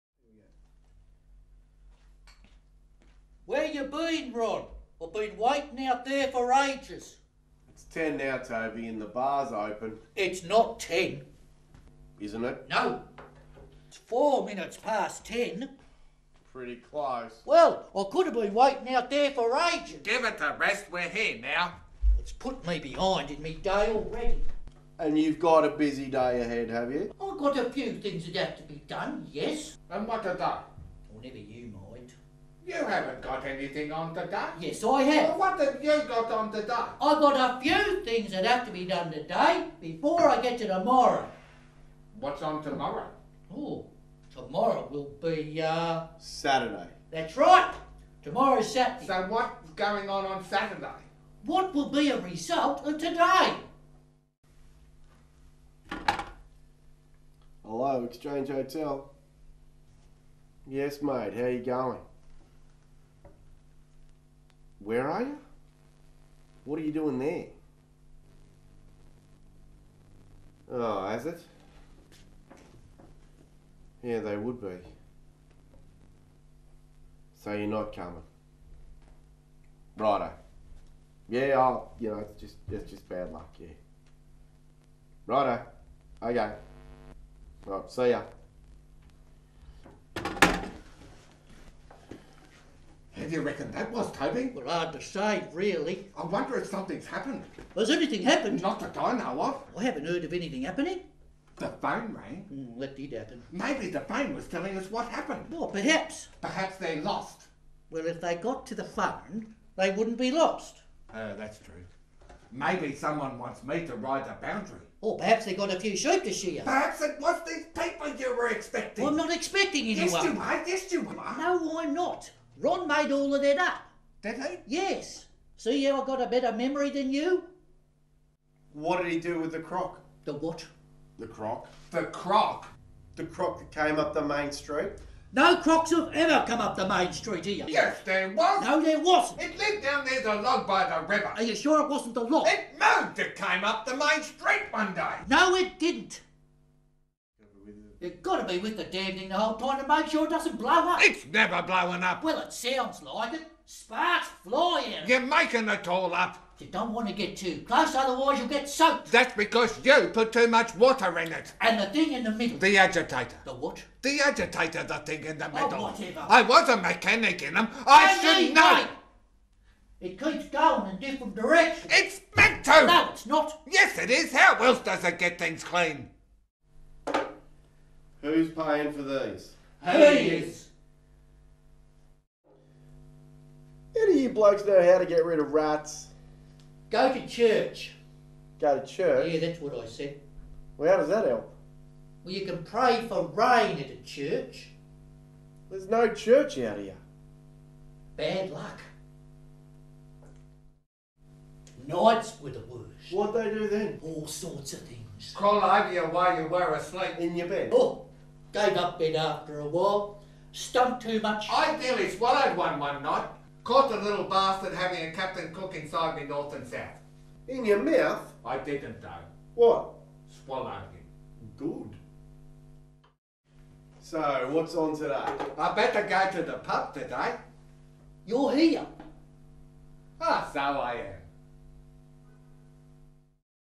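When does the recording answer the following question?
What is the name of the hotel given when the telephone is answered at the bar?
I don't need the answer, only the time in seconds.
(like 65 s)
58 s.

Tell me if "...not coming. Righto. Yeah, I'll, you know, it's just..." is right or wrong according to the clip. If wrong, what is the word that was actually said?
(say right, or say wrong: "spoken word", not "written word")
right.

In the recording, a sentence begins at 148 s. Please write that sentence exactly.
You've got to be with the damn thing the whole time to make sure it doesn't blow up.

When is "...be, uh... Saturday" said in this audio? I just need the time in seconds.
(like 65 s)
45 s.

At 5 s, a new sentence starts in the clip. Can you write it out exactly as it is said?
I've been waiting out there for ages.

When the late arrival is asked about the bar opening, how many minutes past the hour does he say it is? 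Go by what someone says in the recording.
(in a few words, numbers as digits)
4.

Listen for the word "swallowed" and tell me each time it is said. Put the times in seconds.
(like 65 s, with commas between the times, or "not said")
212 s, 220 s.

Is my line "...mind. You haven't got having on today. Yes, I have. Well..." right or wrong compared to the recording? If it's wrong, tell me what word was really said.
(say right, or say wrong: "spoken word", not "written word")
wrong: "anything", not "having".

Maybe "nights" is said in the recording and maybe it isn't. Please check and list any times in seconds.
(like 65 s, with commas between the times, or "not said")
201 s, 213 s.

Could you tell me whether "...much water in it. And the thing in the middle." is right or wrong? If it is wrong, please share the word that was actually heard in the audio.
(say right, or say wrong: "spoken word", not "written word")
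right.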